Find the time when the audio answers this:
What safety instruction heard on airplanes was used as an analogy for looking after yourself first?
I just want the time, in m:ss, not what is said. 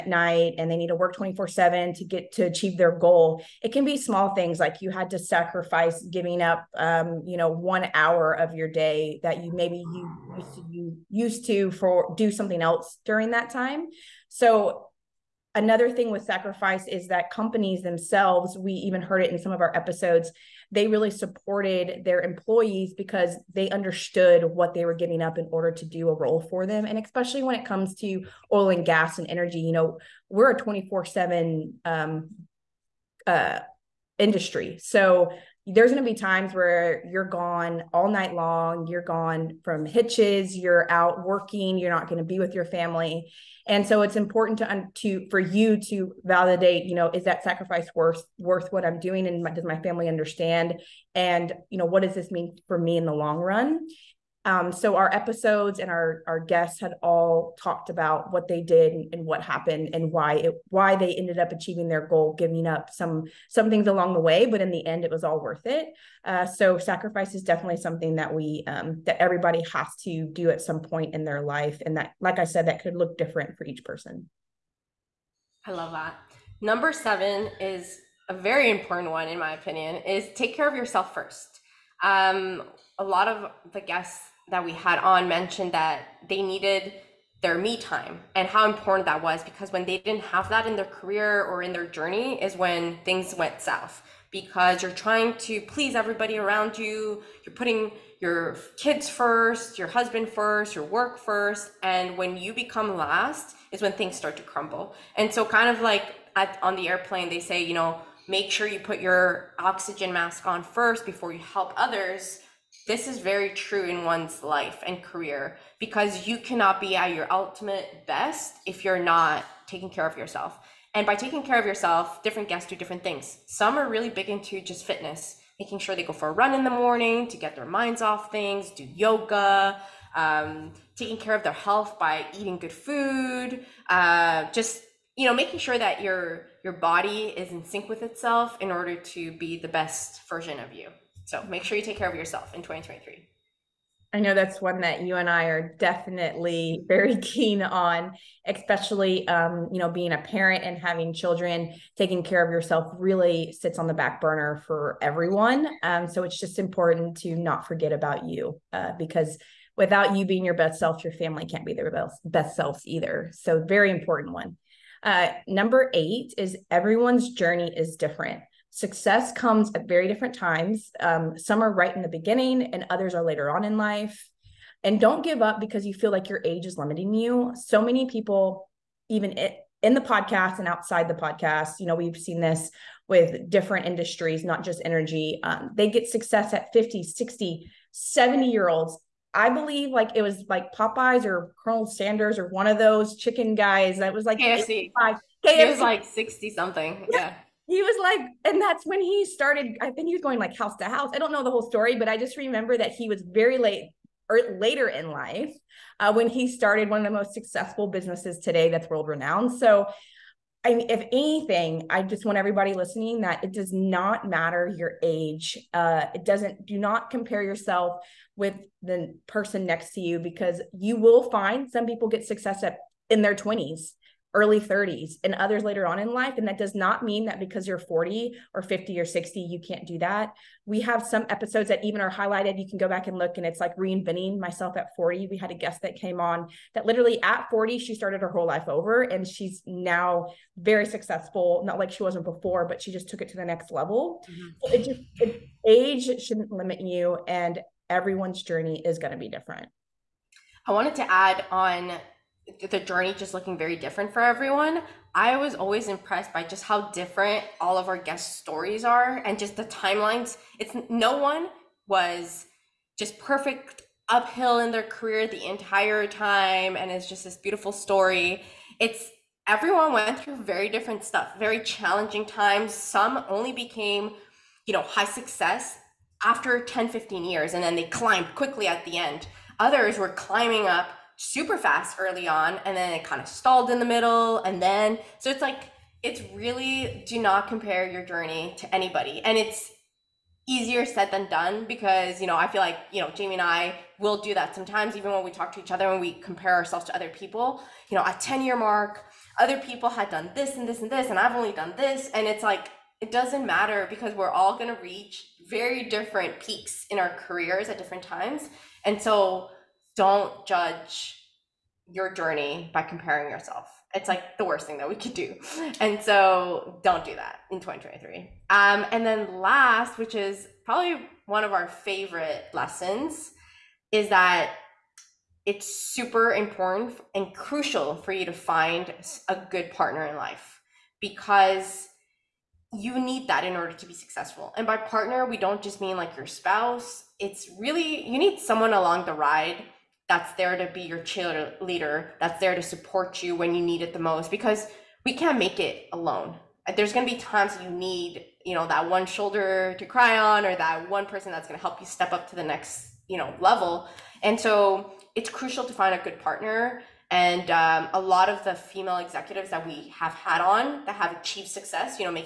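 1:48.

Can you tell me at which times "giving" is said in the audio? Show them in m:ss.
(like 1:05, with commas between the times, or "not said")
0:06, 0:24, 1:02.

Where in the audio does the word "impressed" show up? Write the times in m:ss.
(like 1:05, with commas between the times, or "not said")
4:15.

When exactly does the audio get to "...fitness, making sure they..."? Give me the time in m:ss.
2:04.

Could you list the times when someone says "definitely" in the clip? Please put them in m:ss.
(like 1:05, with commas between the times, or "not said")
1:07, 2:25.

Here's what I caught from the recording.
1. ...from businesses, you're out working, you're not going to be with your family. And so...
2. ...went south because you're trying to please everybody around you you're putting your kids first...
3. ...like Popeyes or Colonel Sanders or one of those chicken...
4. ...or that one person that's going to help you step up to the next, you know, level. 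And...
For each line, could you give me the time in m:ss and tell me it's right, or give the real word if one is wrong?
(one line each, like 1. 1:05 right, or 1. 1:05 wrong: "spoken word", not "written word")
1. 0:39 wrong: "hitches", not "businesses"
2. 1:33 right
3. 3:10 right
4. 5:50 right.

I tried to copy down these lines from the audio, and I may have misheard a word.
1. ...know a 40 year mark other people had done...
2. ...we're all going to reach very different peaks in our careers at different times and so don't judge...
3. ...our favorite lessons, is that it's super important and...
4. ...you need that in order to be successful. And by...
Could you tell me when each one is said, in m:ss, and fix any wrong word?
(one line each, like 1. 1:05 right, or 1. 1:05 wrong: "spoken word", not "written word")
1. 4:57 wrong: "10", not "40"
2. 5:04 right
3. 5:21 right
4. 5:32 right.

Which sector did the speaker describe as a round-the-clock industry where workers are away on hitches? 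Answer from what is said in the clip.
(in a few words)
oil and gas and energy.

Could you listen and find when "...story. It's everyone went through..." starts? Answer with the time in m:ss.
4:27.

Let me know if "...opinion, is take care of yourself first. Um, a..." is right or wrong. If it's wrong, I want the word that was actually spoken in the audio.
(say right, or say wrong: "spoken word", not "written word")
right.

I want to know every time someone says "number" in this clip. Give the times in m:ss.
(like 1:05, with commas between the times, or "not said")
1:16, 2:45.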